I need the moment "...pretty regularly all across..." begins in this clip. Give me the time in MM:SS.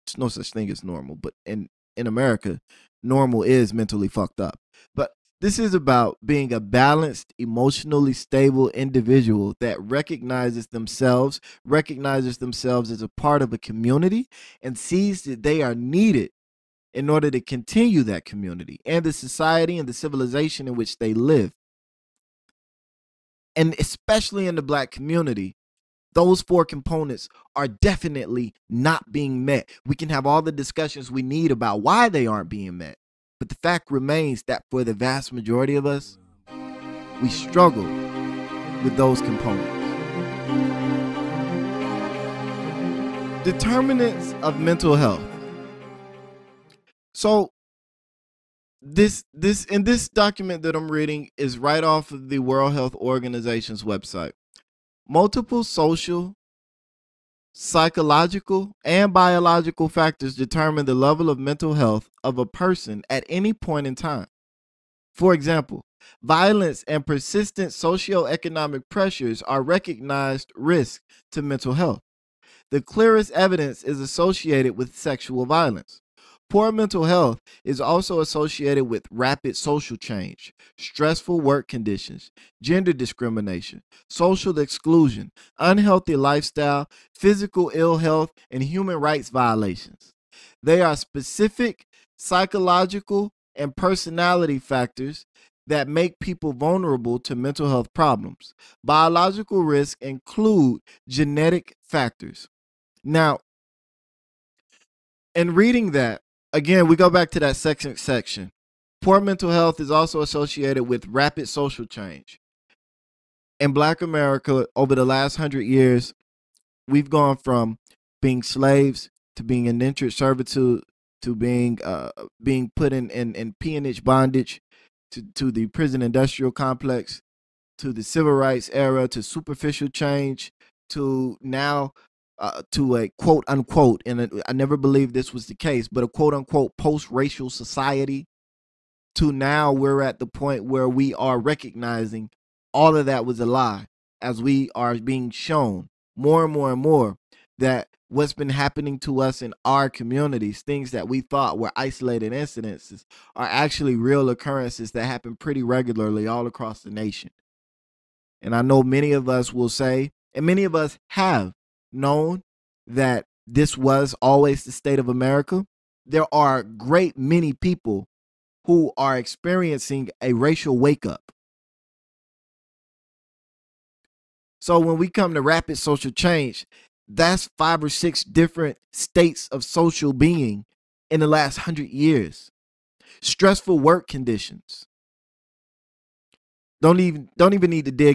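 02:35.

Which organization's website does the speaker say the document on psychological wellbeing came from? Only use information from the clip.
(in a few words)
World Health Organization.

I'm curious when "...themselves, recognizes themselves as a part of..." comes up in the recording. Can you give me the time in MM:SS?
00:10.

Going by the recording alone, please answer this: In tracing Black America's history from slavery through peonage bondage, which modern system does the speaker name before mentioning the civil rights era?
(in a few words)
Prison industrial complex.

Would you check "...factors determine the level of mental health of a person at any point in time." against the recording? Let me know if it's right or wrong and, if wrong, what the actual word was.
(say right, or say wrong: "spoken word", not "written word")
right.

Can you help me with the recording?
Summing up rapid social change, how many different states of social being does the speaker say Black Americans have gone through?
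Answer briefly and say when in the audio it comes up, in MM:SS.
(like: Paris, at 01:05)
5 or 6, at 02:57.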